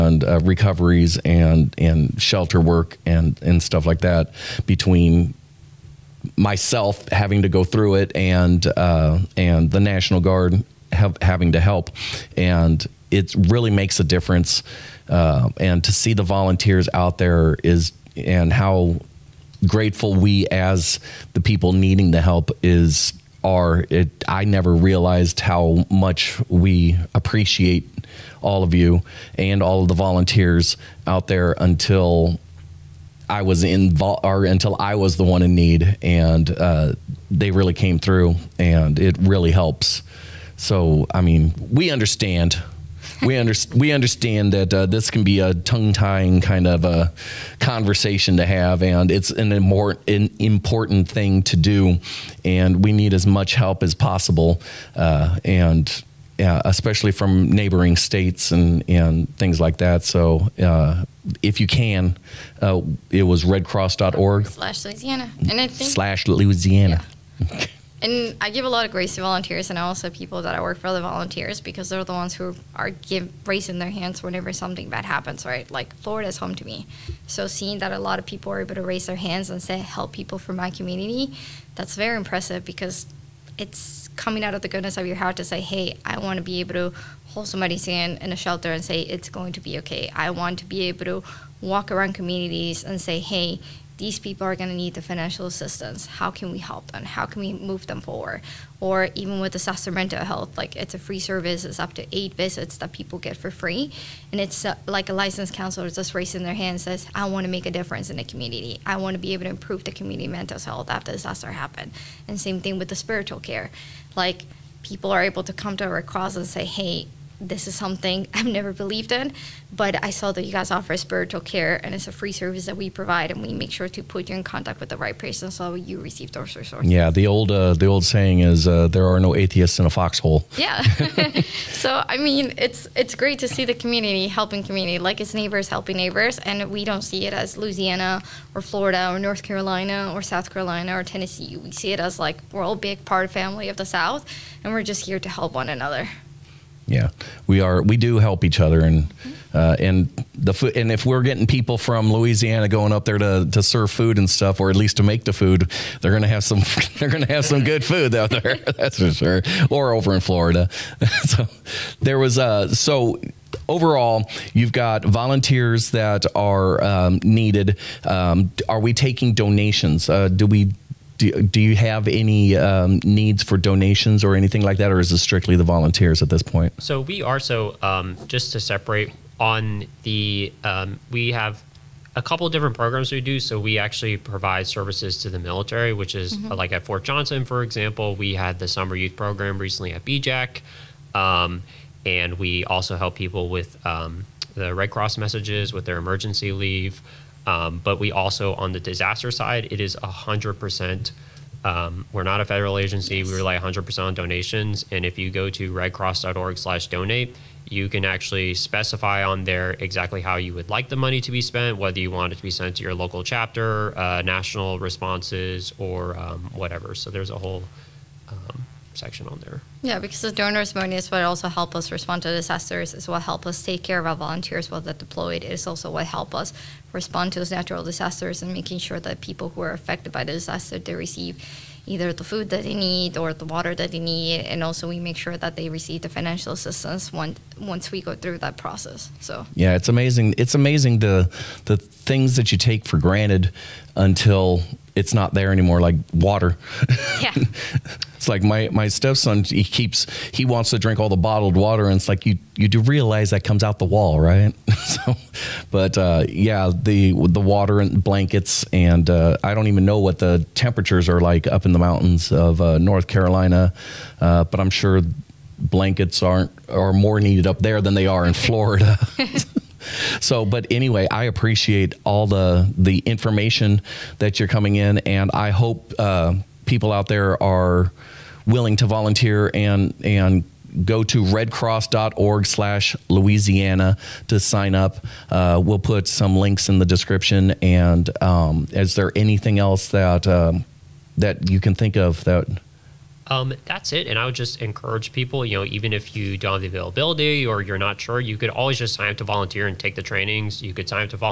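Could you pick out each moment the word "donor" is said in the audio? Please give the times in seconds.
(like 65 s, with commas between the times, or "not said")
220 s.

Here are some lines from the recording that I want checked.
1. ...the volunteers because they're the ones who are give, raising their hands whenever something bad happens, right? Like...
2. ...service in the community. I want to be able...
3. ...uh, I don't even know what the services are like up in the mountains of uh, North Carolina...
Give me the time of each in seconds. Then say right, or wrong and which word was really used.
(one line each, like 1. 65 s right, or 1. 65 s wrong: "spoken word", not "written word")
1. 70 s right
2. 107 s wrong: "difference", not "service"
3. 259 s wrong: "temperatures", not "services".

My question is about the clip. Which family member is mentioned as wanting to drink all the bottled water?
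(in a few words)
stepson.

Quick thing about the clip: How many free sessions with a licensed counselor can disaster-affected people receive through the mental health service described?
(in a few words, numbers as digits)
8.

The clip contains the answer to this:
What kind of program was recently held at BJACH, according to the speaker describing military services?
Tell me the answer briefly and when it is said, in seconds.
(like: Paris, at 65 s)
summer youth program, at 188 s.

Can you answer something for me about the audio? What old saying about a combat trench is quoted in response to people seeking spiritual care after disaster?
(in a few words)
no atheists in a foxhole.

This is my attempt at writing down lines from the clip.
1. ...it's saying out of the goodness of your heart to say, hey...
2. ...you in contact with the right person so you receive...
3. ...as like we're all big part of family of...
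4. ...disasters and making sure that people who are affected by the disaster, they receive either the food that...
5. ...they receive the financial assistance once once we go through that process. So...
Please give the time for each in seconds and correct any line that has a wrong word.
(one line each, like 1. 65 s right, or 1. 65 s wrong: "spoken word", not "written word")
1. 83 s wrong: "coming", not "saying"
2. 124 s right
3. 141 s right
4. 227 s right
5. 235 s right.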